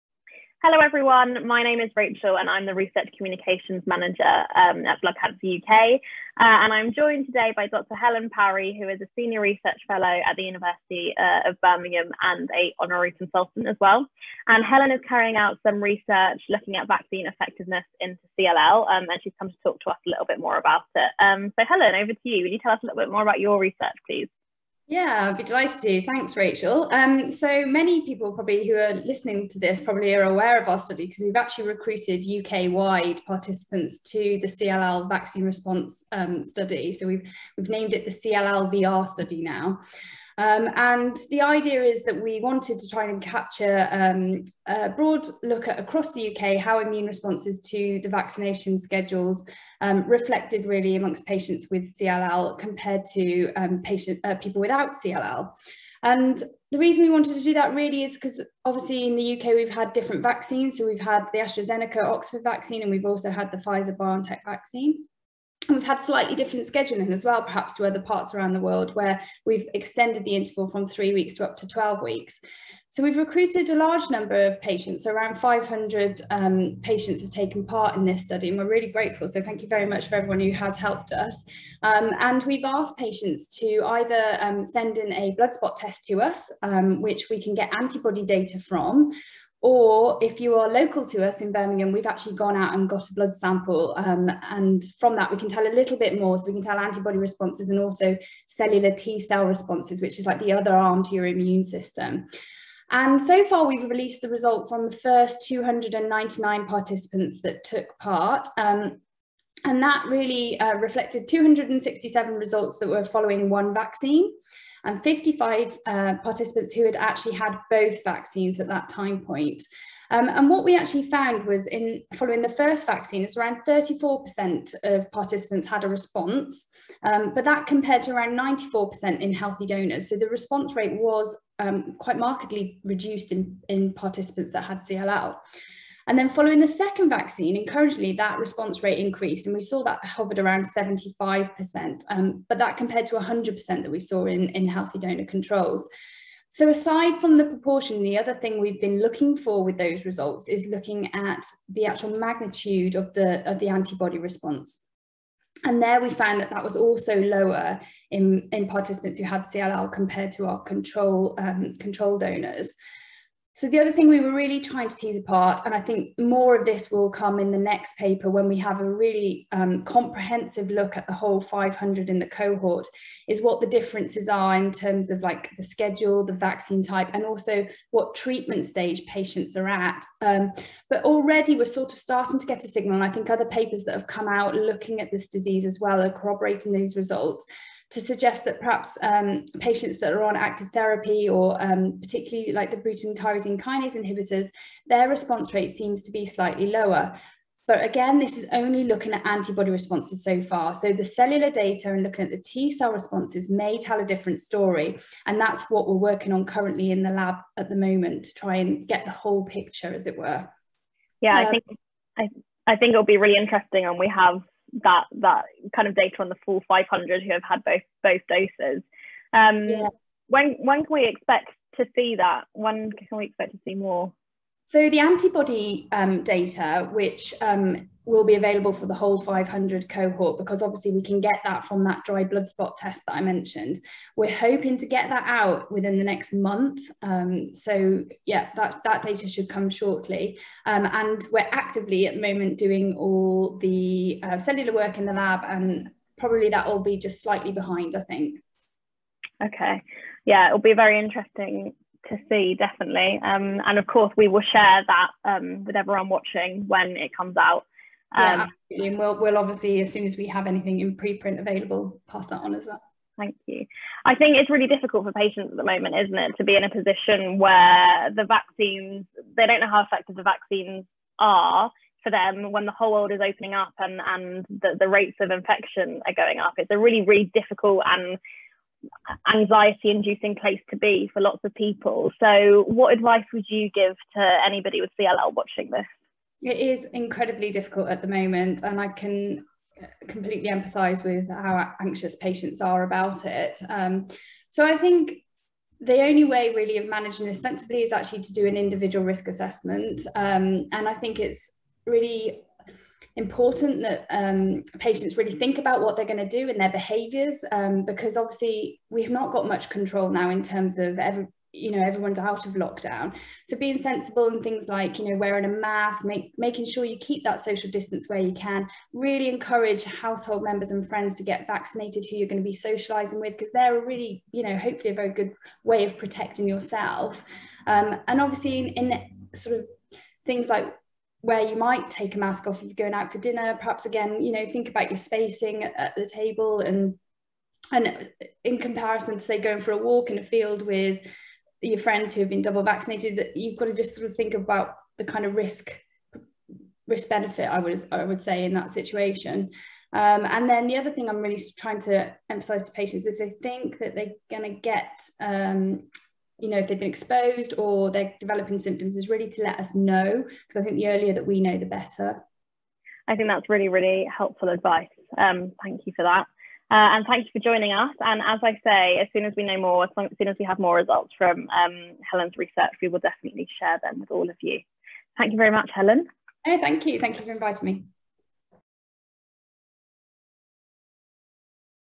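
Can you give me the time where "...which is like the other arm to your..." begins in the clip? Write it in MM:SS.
01:40.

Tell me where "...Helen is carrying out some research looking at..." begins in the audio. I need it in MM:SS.
00:14.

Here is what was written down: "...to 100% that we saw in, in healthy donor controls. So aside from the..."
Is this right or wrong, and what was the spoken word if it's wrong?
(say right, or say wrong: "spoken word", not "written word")
right.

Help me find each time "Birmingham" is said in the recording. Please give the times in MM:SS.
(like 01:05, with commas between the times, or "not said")
00:11, 01:31.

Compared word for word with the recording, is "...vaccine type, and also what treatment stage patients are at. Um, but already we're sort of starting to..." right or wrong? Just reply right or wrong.
right.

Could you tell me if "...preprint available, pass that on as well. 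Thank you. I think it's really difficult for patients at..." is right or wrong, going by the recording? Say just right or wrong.
right.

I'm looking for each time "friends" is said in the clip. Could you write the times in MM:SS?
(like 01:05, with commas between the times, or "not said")
05:20, 05:41.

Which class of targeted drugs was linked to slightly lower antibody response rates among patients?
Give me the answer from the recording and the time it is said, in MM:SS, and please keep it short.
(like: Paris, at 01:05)
Bruton tyrosine kinase inhibitors, at 03:12.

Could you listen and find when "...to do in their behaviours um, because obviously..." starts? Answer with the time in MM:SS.
05:06.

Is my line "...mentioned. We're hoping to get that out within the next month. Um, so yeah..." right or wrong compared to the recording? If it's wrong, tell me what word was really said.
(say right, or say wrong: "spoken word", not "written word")
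right.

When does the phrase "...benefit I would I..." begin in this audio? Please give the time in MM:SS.
05:47.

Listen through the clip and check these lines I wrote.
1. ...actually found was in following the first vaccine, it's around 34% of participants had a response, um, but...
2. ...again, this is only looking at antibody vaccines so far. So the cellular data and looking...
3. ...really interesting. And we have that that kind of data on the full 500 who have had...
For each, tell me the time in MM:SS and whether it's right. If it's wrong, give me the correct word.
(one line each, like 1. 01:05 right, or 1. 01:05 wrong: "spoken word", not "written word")
1. 02:00 right
2. 03:17 wrong: "responses", not "vaccines"
3. 03:33 right.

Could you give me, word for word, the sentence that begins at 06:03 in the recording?
I think that's really, really helpful advice.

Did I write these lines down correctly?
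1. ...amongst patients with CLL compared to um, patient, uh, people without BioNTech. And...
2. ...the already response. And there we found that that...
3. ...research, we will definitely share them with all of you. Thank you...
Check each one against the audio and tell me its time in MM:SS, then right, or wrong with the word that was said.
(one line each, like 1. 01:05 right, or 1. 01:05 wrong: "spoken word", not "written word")
1. 00:50 wrong: "CLL", not "BioNTech"
2. 02:33 wrong: "antibody", not "already"
3. 06:12 right.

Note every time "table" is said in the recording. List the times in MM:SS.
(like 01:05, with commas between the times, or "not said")
05:36.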